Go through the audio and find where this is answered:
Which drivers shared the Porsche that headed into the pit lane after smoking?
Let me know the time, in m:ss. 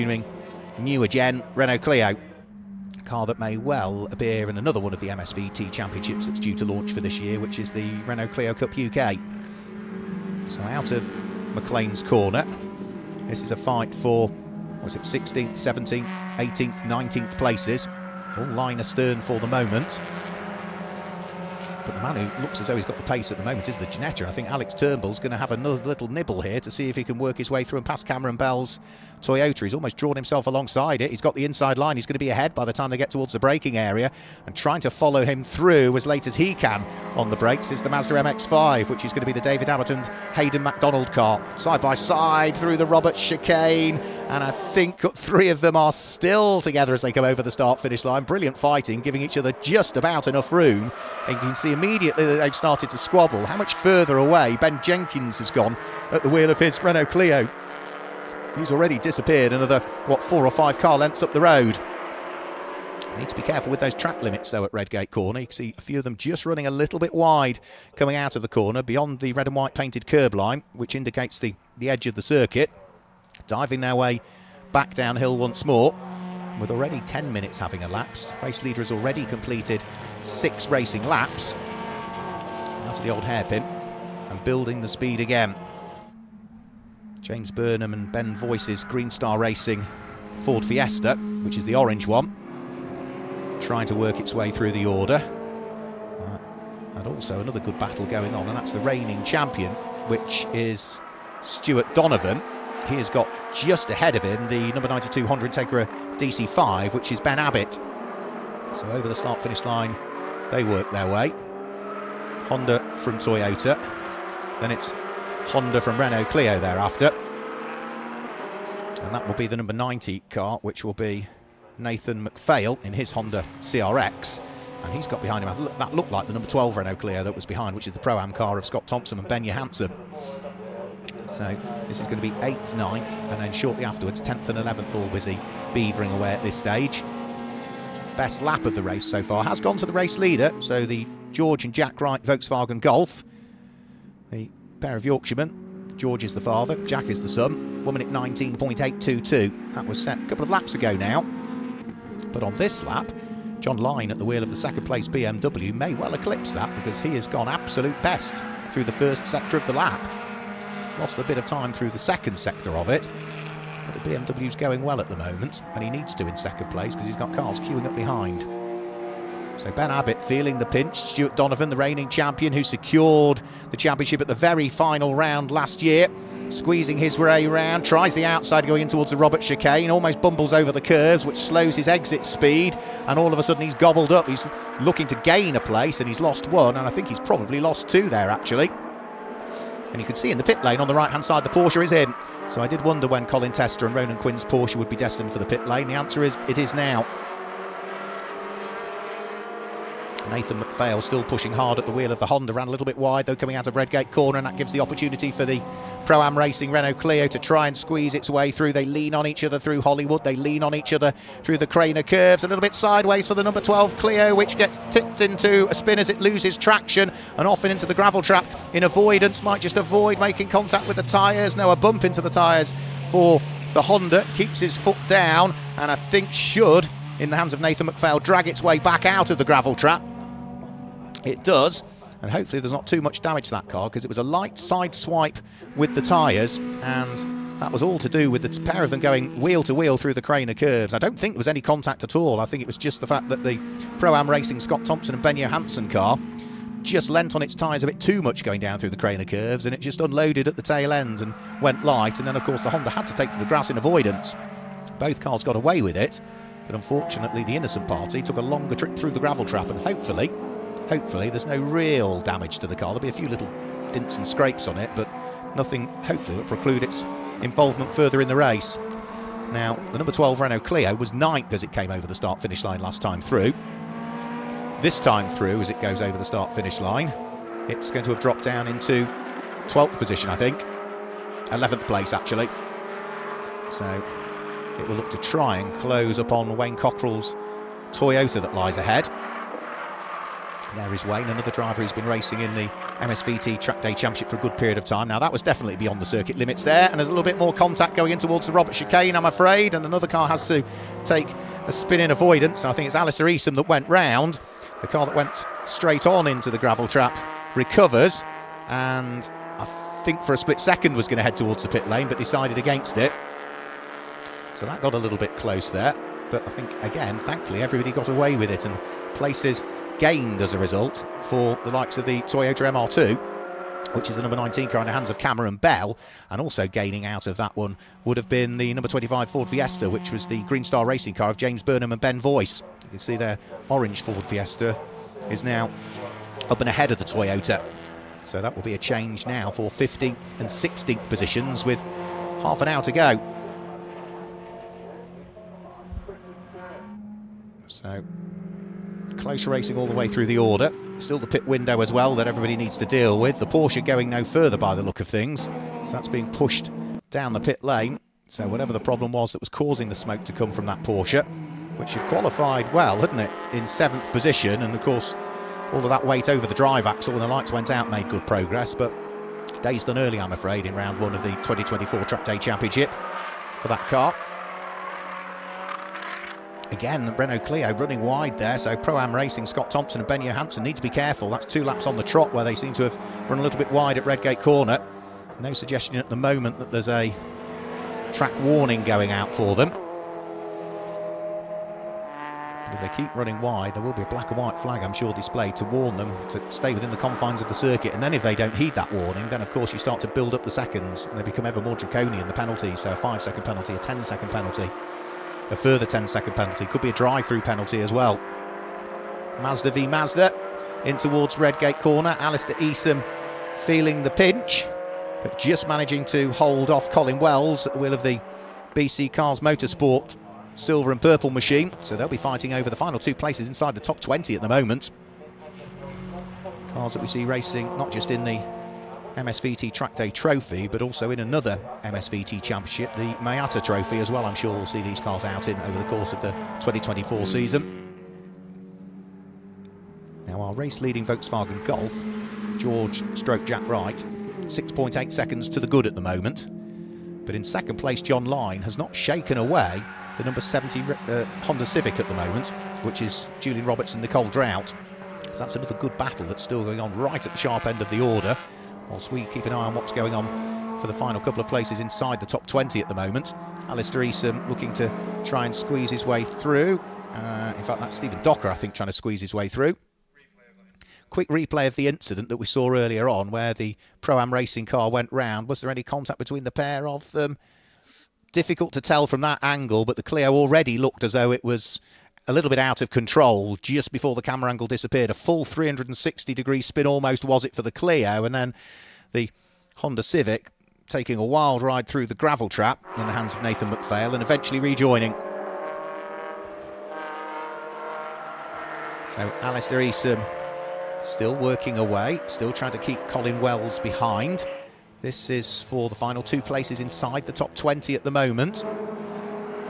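3:13.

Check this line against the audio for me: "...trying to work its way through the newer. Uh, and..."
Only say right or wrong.
wrong.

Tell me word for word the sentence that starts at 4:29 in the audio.
Now, the number 12 Renault Clio was ninth as it came over the start finish line last time through.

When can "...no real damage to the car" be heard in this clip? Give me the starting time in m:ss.
4:21.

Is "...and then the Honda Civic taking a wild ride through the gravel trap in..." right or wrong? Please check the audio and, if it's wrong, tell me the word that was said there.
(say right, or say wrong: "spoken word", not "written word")
right.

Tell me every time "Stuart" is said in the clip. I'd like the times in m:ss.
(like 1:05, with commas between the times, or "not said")
1:41, 2:51.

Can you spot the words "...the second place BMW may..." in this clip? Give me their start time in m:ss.
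2:34.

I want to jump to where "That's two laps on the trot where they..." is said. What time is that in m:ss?
6:21.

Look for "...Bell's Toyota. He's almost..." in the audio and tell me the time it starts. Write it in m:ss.
0:28.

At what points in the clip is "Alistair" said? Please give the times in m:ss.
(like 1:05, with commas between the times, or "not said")
5:02, 6:52, 7:43, 8:19.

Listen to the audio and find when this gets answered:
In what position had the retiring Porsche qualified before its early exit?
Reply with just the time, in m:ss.
6:03.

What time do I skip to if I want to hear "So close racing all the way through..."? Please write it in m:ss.
5:47.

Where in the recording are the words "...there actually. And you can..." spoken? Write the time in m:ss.
3:08.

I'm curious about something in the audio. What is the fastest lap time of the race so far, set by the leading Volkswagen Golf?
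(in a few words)
1:19.822.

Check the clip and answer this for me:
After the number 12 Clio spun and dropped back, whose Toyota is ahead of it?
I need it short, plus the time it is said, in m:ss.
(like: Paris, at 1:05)
Wayne Cockrell, at 4:46.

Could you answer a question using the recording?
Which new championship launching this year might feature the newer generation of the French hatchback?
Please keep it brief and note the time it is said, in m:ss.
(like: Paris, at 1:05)
Renault Clio Cup UK, at 0:08.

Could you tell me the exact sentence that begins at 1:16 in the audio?
With already 10 minutes having elapsed, race leader has already completed six racing laps.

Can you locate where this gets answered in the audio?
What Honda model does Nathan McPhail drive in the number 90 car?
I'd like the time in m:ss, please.
2:03.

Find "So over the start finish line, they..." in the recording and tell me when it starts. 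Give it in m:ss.
1:48.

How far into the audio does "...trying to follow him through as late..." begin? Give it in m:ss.
0:34.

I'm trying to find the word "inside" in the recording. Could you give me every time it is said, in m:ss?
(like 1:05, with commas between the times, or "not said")
0:31, 7:03, 7:41, 8:26.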